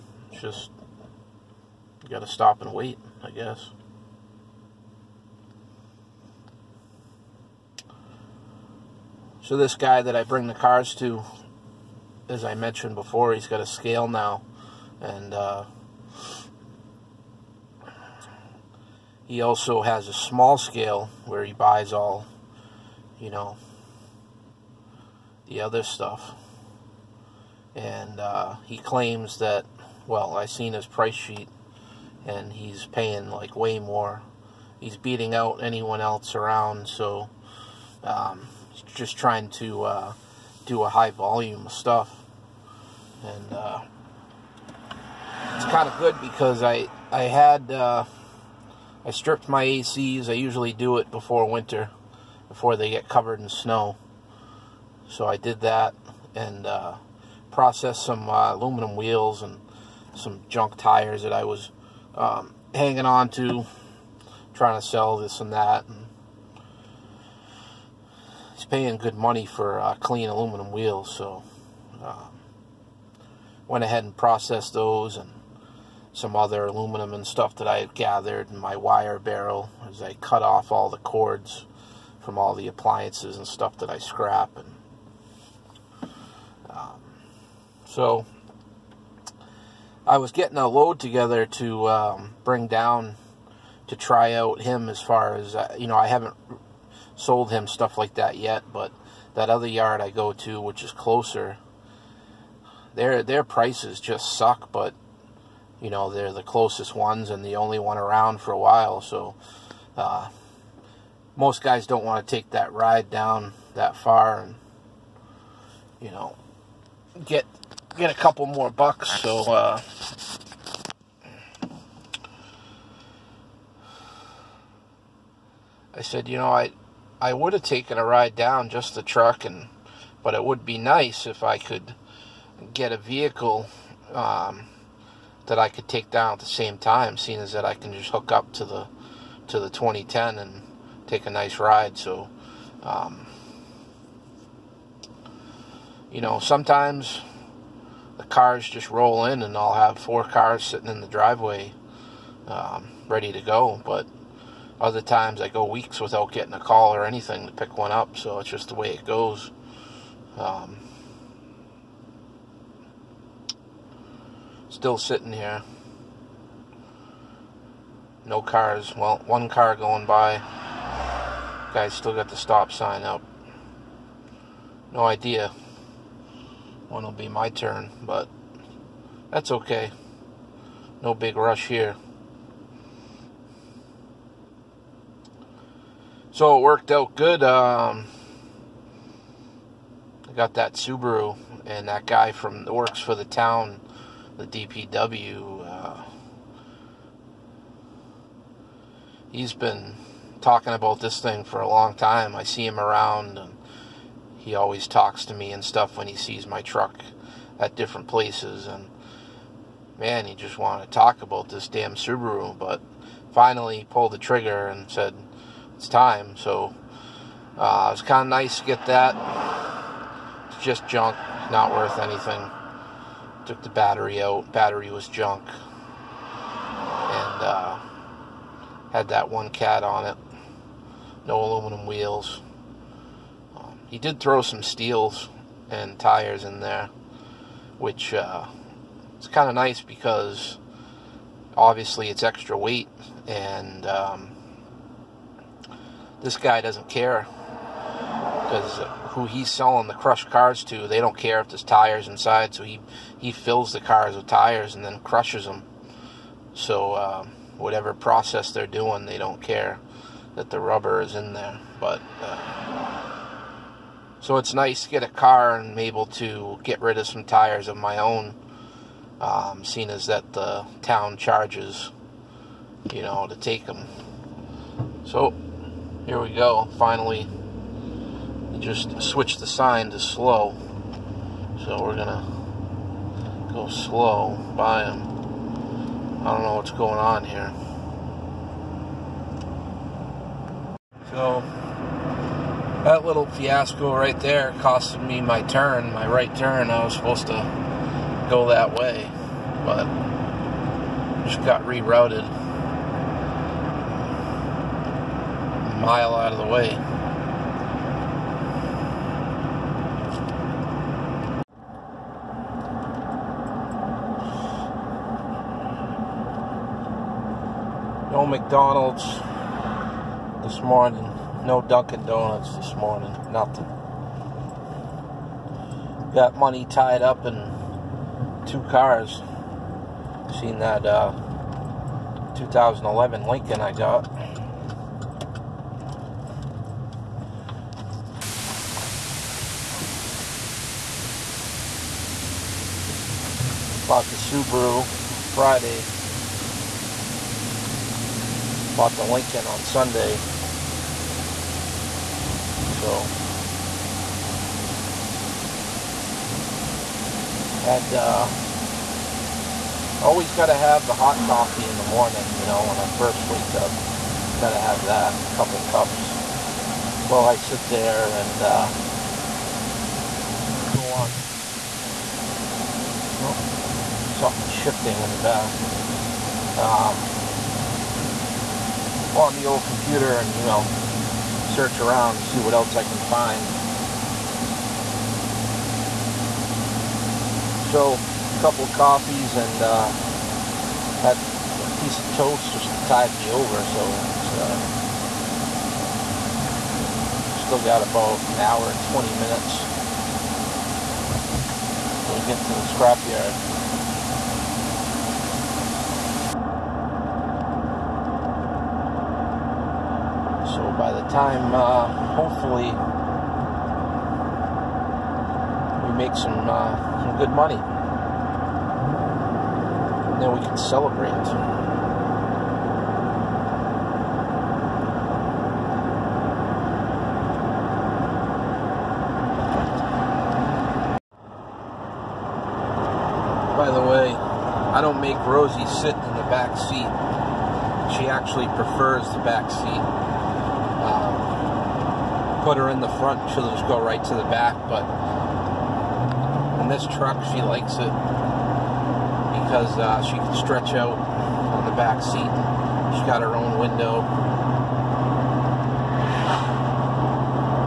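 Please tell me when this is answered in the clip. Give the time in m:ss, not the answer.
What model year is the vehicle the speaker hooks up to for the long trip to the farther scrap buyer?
2:19.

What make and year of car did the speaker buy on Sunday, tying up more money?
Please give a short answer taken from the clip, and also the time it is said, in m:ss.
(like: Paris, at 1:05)
2011 Lincoln, at 5:32.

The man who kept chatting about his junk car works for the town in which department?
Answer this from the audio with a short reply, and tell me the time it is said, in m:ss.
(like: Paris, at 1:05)
DPW, at 3:14.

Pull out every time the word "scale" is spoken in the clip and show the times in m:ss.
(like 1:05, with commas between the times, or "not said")
0:13, 0:20.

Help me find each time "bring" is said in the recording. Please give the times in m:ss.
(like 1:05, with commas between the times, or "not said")
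0:10, 1:32.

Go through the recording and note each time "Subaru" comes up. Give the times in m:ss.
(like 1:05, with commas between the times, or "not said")
3:10, 3:31, 5:44.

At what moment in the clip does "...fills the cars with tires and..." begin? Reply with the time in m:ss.
4:13.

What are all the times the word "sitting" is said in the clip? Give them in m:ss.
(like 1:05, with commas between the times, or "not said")
2:30, 2:44.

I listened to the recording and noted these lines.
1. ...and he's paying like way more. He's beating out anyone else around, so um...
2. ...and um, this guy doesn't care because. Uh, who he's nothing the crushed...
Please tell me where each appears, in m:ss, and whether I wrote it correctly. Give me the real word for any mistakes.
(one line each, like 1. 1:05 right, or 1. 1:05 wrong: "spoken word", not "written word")
1. 0:32 right
2. 4:03 wrong: "selling", not "nothing".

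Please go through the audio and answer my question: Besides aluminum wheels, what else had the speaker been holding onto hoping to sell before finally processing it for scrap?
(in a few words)
Junk tires.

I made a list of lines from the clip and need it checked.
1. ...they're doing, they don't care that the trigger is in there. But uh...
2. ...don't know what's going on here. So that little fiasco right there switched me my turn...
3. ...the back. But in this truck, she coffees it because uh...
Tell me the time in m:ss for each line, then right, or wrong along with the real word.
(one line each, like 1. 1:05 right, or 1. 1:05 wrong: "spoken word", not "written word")
1. 4:18 wrong: "rubber", not "trigger"
2. 4:46 wrong: "costed", not "switched"
3. 7:24 wrong: "likes", not "coffees".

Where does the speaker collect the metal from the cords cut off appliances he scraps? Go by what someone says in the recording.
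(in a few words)
Wire barrel.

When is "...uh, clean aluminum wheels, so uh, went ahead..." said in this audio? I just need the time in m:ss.
1:09.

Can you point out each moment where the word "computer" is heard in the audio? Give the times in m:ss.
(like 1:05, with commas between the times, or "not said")
6:19.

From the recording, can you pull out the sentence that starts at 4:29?
Um, seeing as that the town charges, you know, to take them.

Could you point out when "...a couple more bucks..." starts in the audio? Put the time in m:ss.
1:58.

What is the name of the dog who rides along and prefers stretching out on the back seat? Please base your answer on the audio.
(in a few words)
Rosie.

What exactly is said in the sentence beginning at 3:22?
I see him around, and he always talks to me and stuff when he sees my truck at different places.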